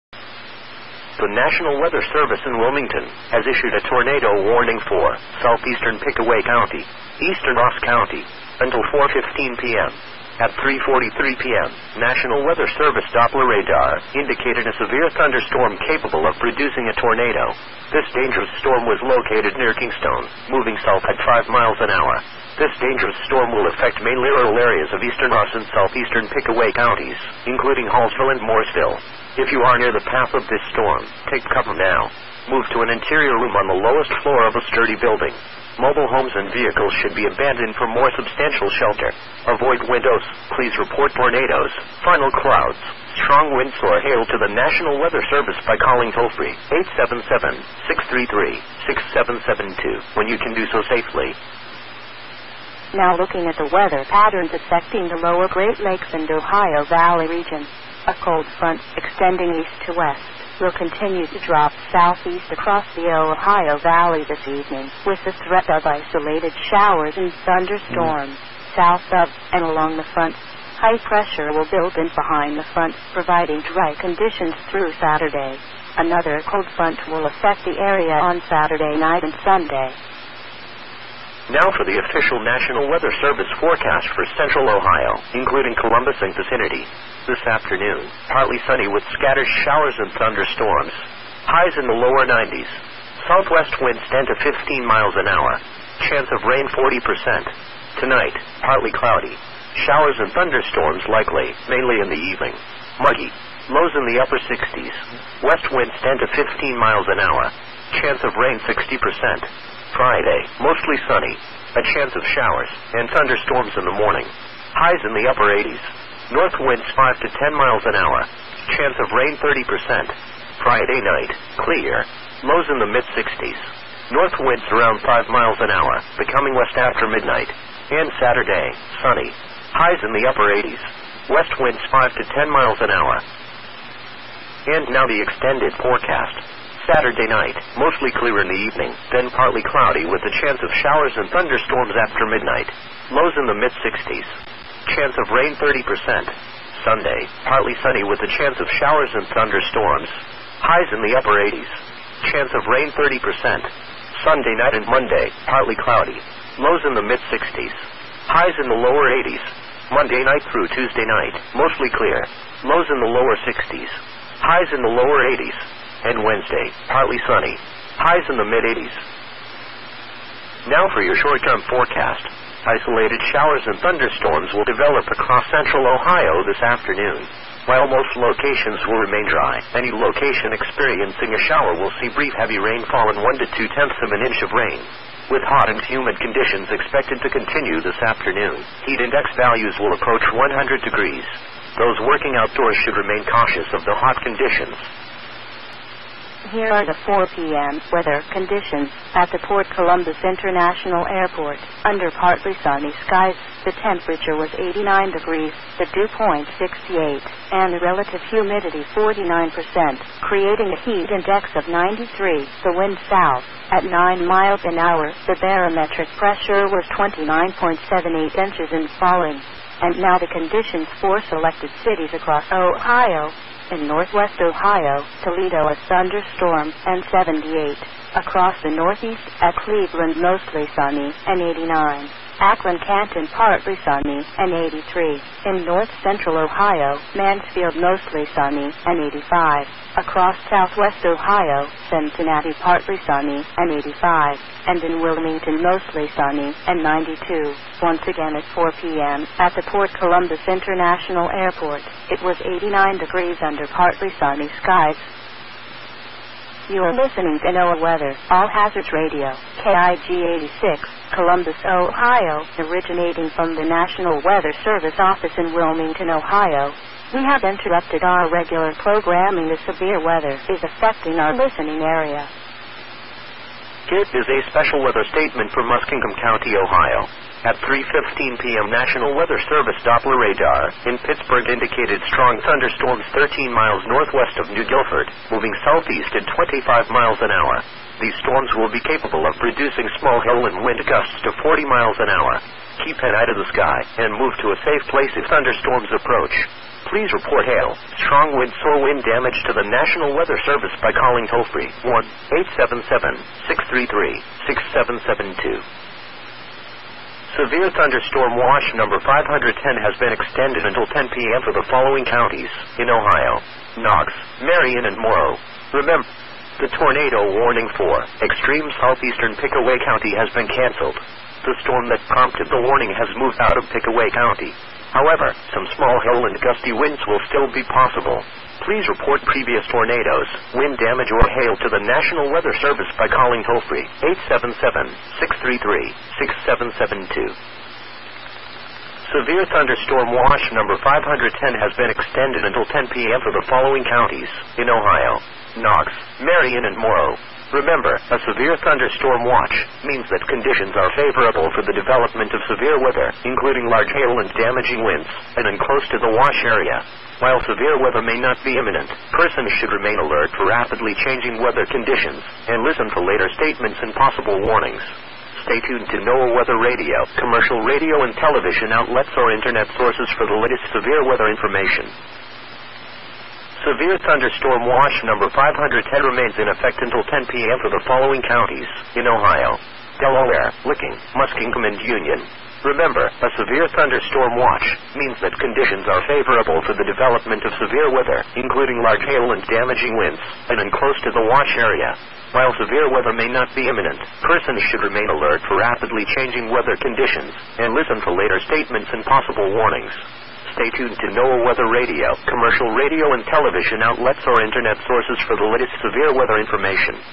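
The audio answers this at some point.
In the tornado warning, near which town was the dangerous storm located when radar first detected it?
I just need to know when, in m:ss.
0:19.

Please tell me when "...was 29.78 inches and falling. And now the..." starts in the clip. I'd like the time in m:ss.
3:36.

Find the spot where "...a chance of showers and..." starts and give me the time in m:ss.
1:51.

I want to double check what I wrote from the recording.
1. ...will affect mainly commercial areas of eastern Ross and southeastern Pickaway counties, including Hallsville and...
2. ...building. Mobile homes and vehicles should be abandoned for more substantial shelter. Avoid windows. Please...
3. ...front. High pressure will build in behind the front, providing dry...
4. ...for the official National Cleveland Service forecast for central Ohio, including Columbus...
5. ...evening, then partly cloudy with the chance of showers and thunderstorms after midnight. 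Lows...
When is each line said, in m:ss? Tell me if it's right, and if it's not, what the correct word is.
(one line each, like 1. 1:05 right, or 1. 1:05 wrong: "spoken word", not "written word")
1. 0:23 wrong: "rural", not "commercial"
2. 0:34 right
3. 1:10 right
4. 1:21 wrong: "Weather", not "Cleveland"
5. 2:18 right.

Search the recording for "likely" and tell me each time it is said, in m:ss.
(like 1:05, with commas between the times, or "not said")
1:41.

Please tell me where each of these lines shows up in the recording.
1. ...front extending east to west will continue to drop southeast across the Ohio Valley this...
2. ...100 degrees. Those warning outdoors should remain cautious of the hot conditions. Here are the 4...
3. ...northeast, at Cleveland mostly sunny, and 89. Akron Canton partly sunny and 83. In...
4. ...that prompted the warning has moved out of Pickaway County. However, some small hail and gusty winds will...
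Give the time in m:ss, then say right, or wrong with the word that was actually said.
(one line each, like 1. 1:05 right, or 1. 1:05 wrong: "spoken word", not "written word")
1. 0:58 right
2. 3:10 wrong: "working", not "warning"
3. 3:48 right
4. 5:21 right.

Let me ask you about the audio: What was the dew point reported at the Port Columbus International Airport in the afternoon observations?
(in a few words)
68.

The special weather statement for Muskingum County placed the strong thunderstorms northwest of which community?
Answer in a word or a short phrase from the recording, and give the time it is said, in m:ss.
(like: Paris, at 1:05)
New Guilford, at 4:44.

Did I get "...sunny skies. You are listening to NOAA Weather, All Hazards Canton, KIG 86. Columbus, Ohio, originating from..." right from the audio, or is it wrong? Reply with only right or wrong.
wrong.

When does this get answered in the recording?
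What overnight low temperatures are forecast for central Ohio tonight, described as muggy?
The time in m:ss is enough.
1:44.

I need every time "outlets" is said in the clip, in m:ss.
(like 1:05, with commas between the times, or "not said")
6:08, 6:43.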